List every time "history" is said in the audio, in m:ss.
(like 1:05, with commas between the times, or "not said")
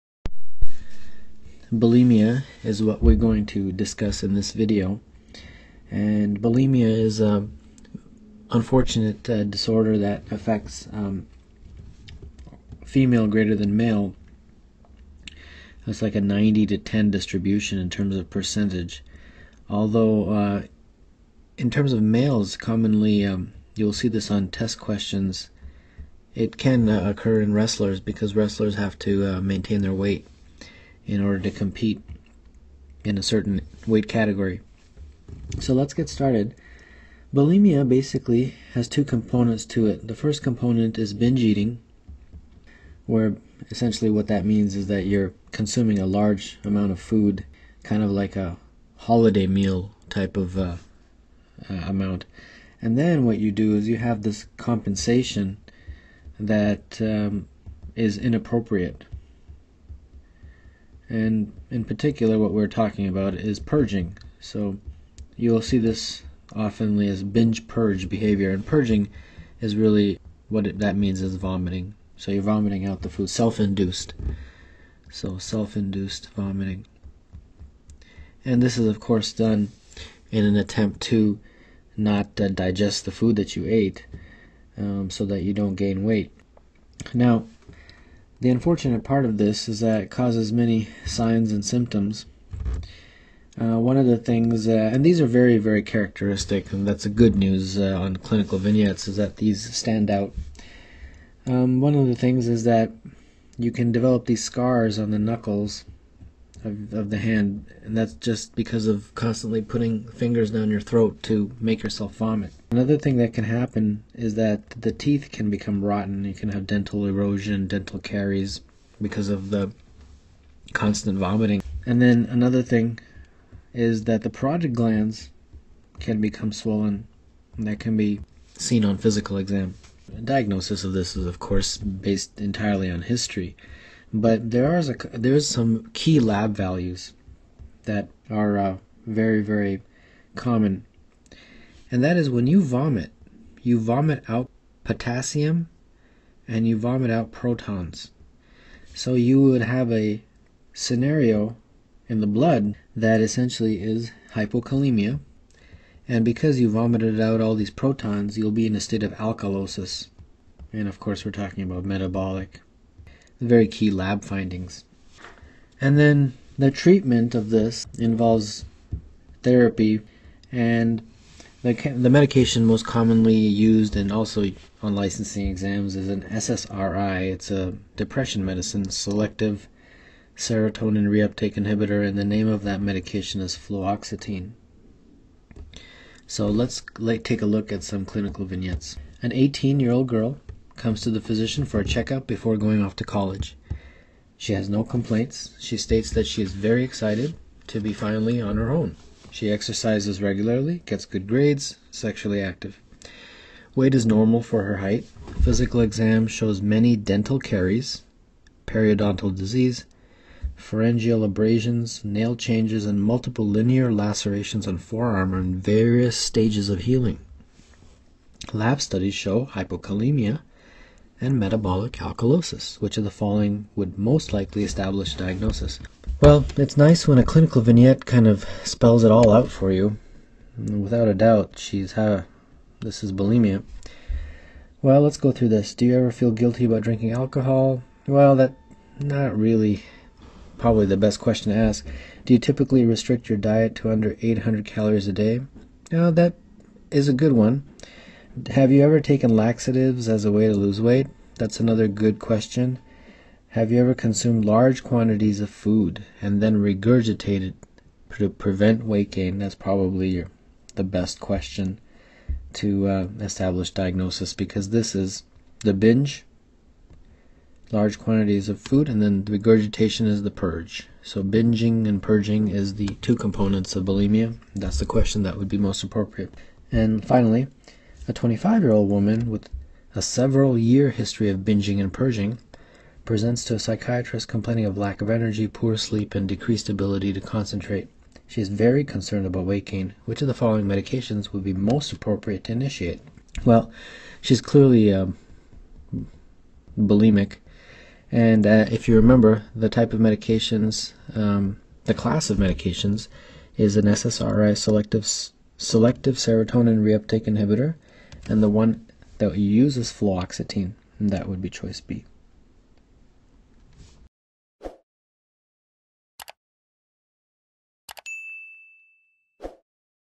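2:13, 4:40.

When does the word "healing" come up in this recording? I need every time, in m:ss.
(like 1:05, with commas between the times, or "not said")
3:36.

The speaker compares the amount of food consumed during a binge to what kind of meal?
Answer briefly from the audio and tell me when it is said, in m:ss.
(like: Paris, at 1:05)
A holiday meal, at 0:48.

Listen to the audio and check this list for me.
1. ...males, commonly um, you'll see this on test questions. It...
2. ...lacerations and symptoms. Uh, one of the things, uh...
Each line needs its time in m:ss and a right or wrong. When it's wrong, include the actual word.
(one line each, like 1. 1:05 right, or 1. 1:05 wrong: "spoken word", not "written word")
1. 0:22 right
2. 1:31 wrong: "signs", not "lacerations".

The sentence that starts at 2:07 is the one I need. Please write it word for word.
That can be seen on physical exam.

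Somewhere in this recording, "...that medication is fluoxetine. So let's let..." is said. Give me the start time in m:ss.
3:02.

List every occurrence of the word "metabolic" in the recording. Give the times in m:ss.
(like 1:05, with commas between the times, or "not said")
2:41, 3:41.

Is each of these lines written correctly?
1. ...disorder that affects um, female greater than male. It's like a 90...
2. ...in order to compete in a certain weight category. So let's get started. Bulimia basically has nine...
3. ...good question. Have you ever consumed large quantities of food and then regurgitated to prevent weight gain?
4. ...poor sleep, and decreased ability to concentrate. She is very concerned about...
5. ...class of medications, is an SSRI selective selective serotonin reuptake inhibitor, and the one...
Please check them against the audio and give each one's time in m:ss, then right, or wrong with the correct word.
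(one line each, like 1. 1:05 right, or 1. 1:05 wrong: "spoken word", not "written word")
1. 0:09 right
2. 0:31 wrong: "two", not "nine"
3. 4:11 right
4. 4:45 right
5. 5:01 right.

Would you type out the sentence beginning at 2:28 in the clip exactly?
So you would have a scenario in the blood that essentially is hypokalemia.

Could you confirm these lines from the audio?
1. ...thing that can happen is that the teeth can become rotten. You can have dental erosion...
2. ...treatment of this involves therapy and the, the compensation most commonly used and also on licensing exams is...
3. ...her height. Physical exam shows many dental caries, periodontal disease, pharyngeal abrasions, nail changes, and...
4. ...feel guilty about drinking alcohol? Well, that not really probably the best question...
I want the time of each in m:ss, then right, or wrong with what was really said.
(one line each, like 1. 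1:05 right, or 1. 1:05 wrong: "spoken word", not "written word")
1. 1:52 right
2. 2:46 wrong: "medication", not "compensation"
3. 3:24 right
4. 3:56 right.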